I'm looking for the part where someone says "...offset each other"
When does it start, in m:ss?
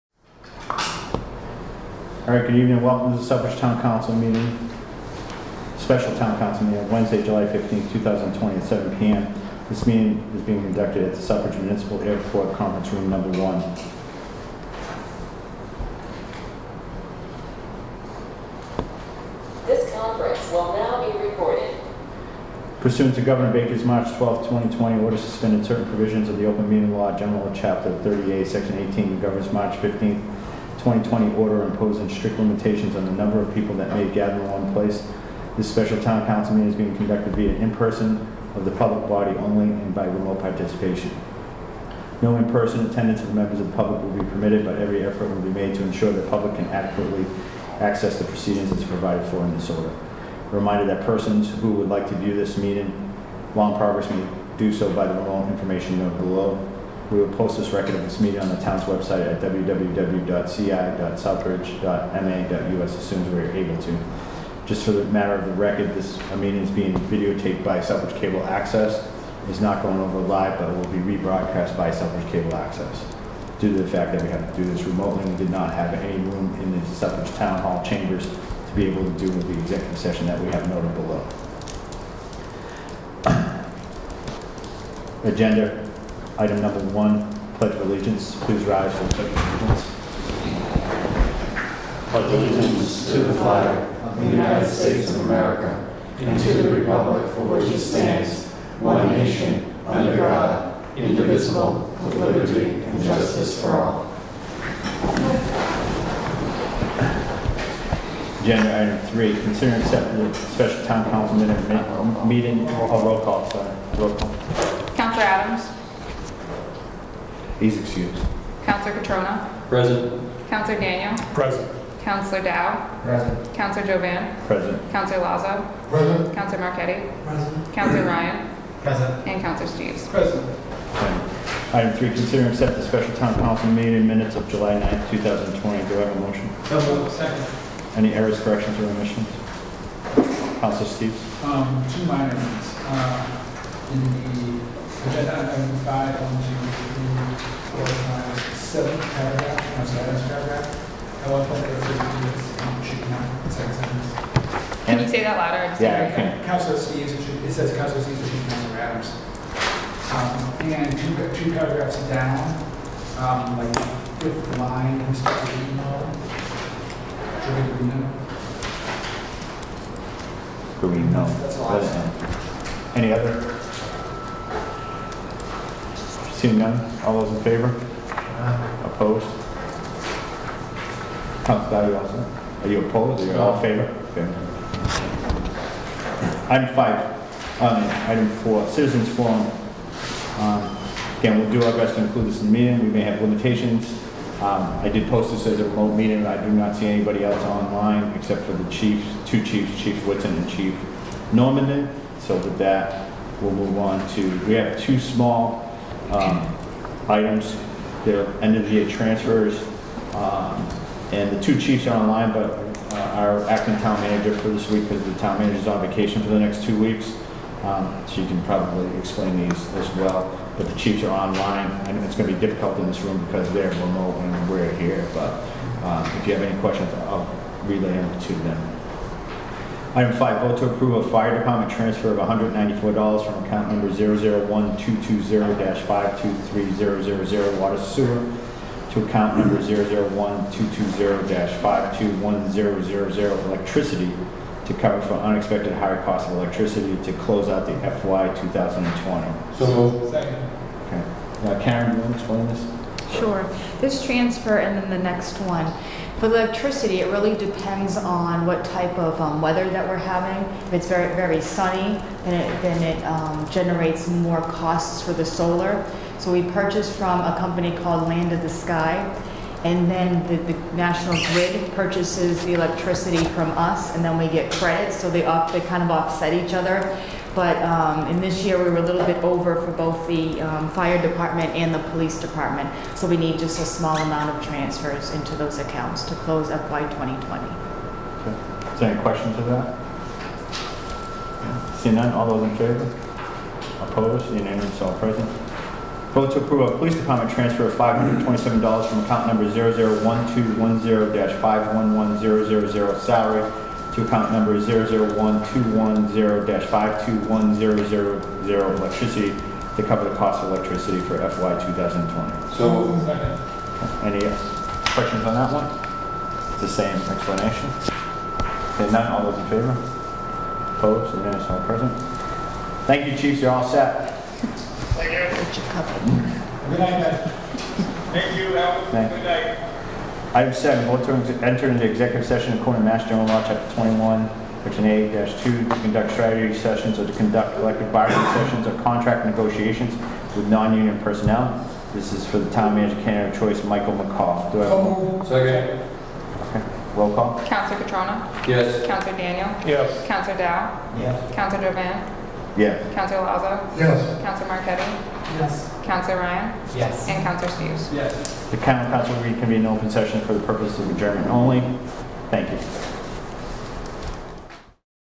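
4:35.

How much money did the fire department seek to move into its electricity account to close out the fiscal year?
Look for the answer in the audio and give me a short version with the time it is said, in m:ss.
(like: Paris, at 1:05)
$194, at 3:52.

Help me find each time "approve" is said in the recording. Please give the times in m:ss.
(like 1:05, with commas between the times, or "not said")
3:50, 4:56.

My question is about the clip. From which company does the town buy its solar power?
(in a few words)
Land of the Sky.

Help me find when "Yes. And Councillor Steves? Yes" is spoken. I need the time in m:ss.
5:56.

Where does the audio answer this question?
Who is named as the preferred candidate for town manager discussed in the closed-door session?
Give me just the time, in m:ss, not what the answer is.
5:43.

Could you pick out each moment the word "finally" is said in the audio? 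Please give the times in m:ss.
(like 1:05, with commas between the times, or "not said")
not said.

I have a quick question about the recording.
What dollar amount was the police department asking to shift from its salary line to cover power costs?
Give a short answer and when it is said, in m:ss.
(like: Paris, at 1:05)
$527, at 4:57.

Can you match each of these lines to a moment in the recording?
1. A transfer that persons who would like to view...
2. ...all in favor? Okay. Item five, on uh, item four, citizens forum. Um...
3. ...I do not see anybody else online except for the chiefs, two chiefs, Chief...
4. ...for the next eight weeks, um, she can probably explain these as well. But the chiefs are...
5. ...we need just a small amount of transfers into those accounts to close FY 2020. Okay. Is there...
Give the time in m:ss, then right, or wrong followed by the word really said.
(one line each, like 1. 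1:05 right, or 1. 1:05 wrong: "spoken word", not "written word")
1. 0:50 wrong: "reminder", not "transfer"
2. 3:03 right
3. 3:16 right
4. 3:36 wrong: "two", not "eight"
5. 4:43 right.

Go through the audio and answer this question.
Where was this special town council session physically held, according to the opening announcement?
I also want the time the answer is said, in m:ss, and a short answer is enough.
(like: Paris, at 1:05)
Southbridge Municipal Airport, at 0:11.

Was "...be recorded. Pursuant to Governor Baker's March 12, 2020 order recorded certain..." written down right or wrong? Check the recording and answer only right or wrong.
wrong.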